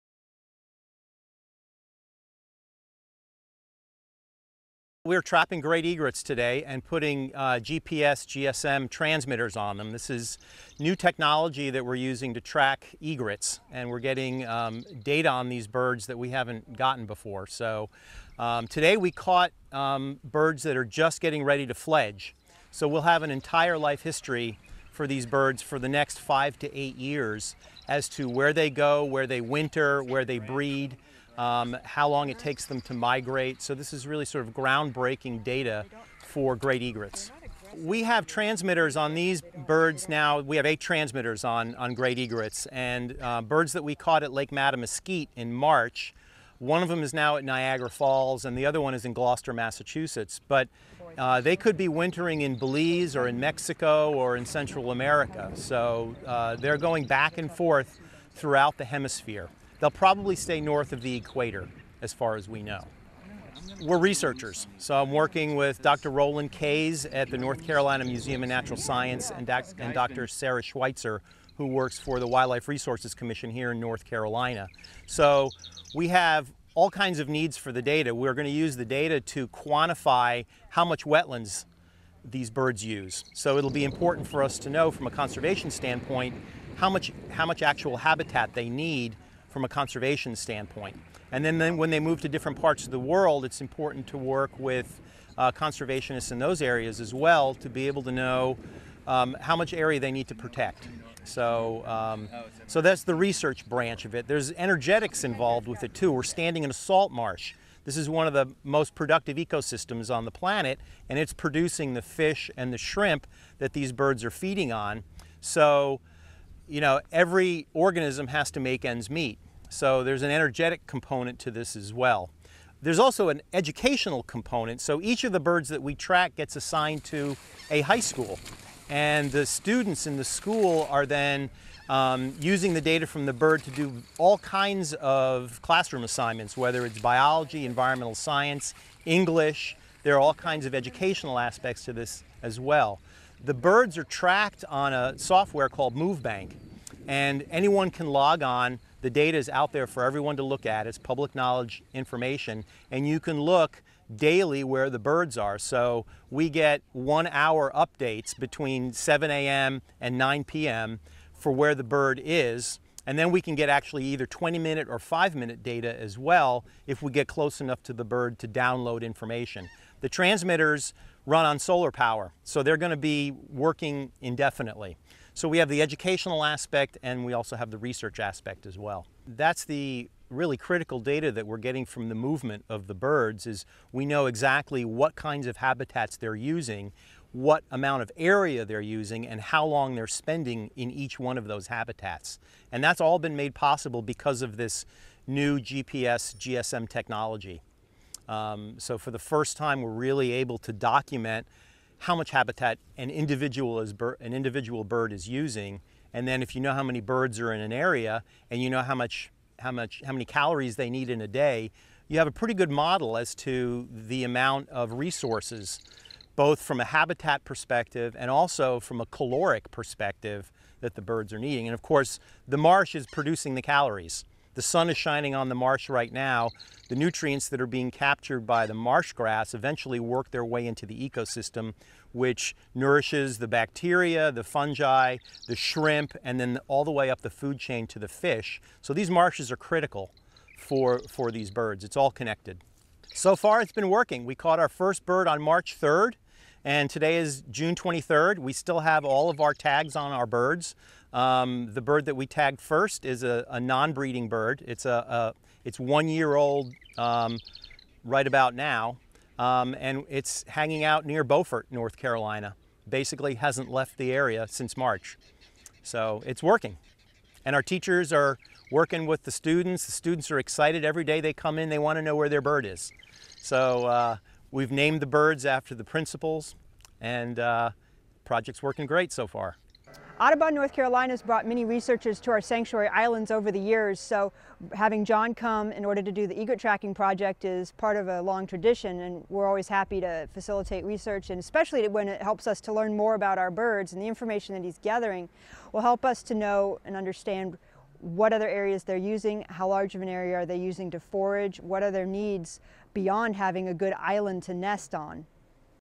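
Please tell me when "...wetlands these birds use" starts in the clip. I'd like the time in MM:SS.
01:21.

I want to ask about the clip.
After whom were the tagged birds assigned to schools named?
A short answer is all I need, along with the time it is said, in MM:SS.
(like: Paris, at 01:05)
The principals, at 04:35.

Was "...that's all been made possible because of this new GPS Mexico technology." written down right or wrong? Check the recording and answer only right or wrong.
wrong.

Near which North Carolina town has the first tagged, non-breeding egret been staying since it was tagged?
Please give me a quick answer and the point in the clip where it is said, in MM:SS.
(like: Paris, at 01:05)
Beaufort, at 04:21.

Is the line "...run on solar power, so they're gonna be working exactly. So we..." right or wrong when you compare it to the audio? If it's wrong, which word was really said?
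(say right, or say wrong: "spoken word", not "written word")
wrong: "indefinitely", not "exactly".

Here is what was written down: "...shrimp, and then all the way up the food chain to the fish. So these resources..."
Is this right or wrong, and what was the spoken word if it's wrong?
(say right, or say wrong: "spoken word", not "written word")
wrong: "marshes", not "resources".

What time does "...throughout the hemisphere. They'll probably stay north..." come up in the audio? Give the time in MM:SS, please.
00:58.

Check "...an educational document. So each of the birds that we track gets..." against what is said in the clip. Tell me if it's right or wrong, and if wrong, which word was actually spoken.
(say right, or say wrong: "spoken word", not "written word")
wrong: "component", not "document".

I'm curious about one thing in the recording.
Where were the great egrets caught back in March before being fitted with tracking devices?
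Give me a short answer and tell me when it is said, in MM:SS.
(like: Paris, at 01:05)
Lake Mattamuskeet, at 00:44.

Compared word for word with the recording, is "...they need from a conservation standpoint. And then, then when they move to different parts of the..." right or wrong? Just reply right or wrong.
right.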